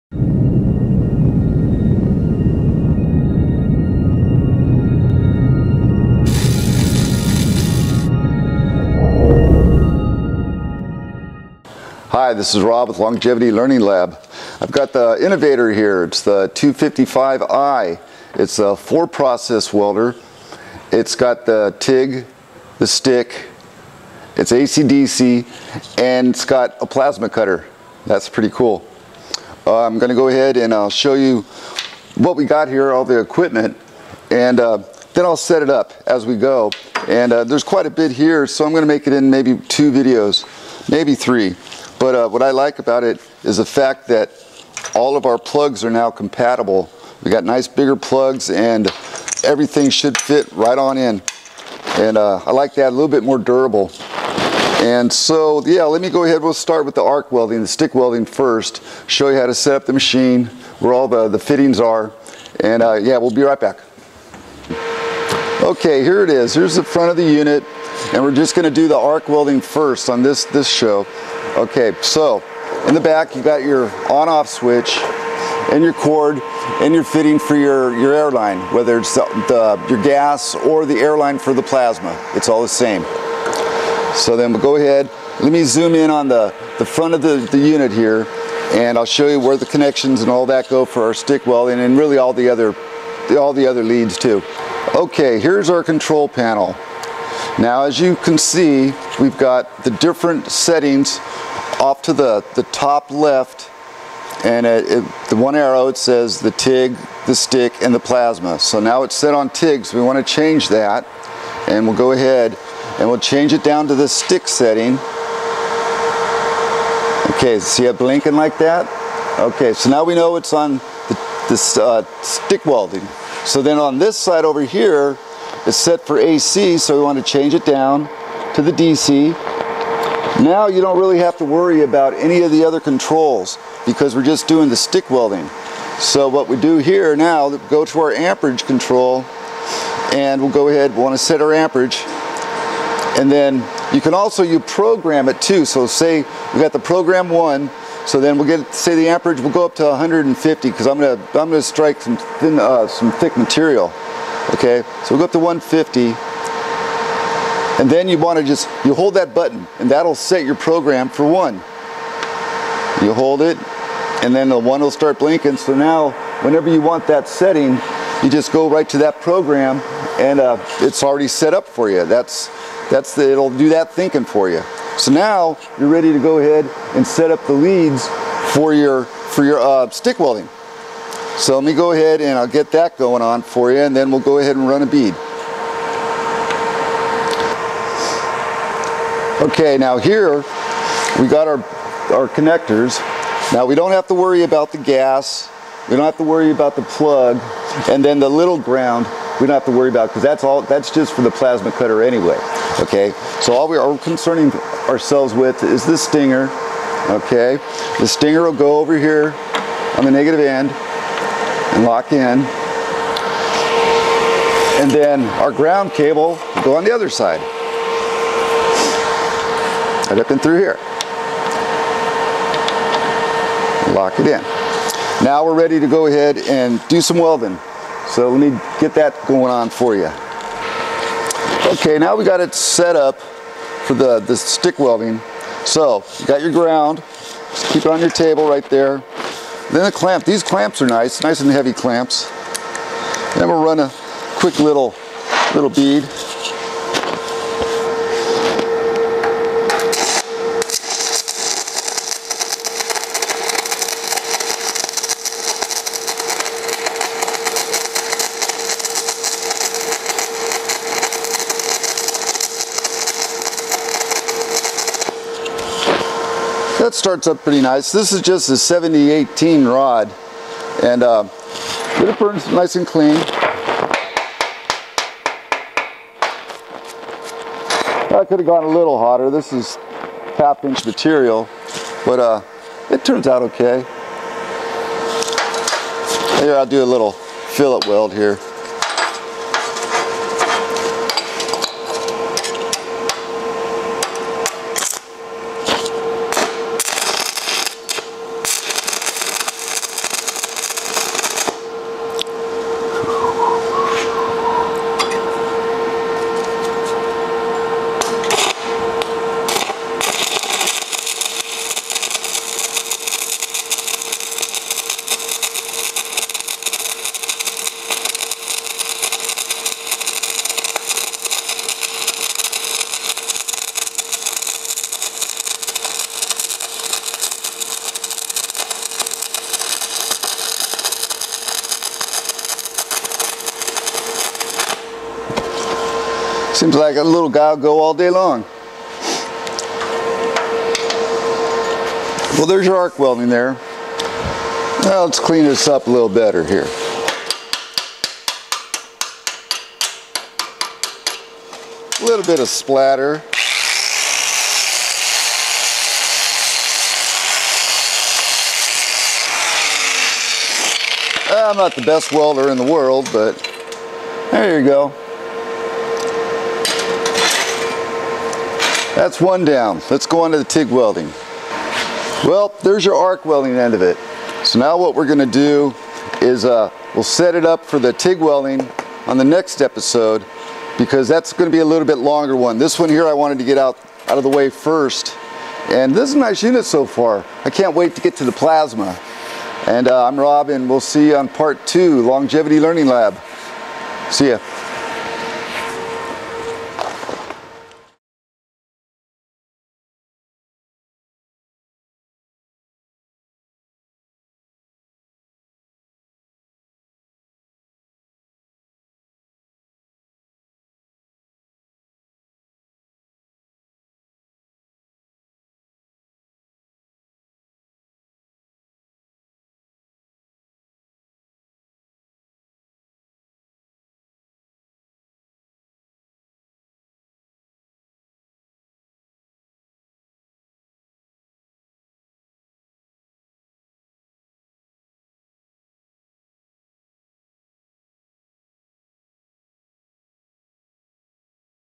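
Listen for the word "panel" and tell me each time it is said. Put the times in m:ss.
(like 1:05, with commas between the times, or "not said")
1:36.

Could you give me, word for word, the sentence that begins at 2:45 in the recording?
So now whenever you want that setting, you just go right to that program and uh, it's already set up for you.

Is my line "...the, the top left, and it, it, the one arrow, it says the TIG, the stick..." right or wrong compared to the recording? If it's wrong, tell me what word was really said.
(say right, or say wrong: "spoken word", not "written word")
right.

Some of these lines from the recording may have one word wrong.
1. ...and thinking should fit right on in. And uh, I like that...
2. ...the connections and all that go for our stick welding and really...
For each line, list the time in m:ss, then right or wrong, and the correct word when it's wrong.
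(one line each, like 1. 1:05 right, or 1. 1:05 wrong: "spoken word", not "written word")
1. 0:48 wrong: "everything", not "thinking"
2. 1:29 right.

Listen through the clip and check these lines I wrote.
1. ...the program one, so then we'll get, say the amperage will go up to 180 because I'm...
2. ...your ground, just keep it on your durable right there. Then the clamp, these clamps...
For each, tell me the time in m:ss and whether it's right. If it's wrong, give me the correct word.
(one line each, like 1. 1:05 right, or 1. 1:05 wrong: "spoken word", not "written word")
1. 2:26 wrong: "150", not "180"
2. 3:56 wrong: "table", not "durable".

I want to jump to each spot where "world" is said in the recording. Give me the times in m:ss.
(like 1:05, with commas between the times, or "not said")
6:02.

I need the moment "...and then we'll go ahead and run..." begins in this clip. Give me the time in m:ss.
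3:03.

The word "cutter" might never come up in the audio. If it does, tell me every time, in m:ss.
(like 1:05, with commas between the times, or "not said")
0:27, 3:21.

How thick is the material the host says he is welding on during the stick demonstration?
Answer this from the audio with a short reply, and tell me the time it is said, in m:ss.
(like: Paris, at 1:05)
half inch, at 4:40.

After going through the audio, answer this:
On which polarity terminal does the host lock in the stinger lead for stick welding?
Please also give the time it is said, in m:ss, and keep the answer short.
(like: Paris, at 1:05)
negative, at 3:30.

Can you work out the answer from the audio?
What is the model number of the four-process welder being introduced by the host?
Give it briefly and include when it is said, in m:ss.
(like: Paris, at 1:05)
255i, at 0:16.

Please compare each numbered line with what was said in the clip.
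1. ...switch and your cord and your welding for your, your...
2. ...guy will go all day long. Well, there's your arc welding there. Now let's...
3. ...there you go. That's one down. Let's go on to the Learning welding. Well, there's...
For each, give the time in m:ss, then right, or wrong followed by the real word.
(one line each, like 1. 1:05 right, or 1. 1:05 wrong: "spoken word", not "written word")
1. 1:14 wrong: "fitting", not "welding"
2. 5:37 right
3. 6:04 wrong: "TIG", not "Learning".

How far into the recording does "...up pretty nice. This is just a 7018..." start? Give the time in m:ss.
4:27.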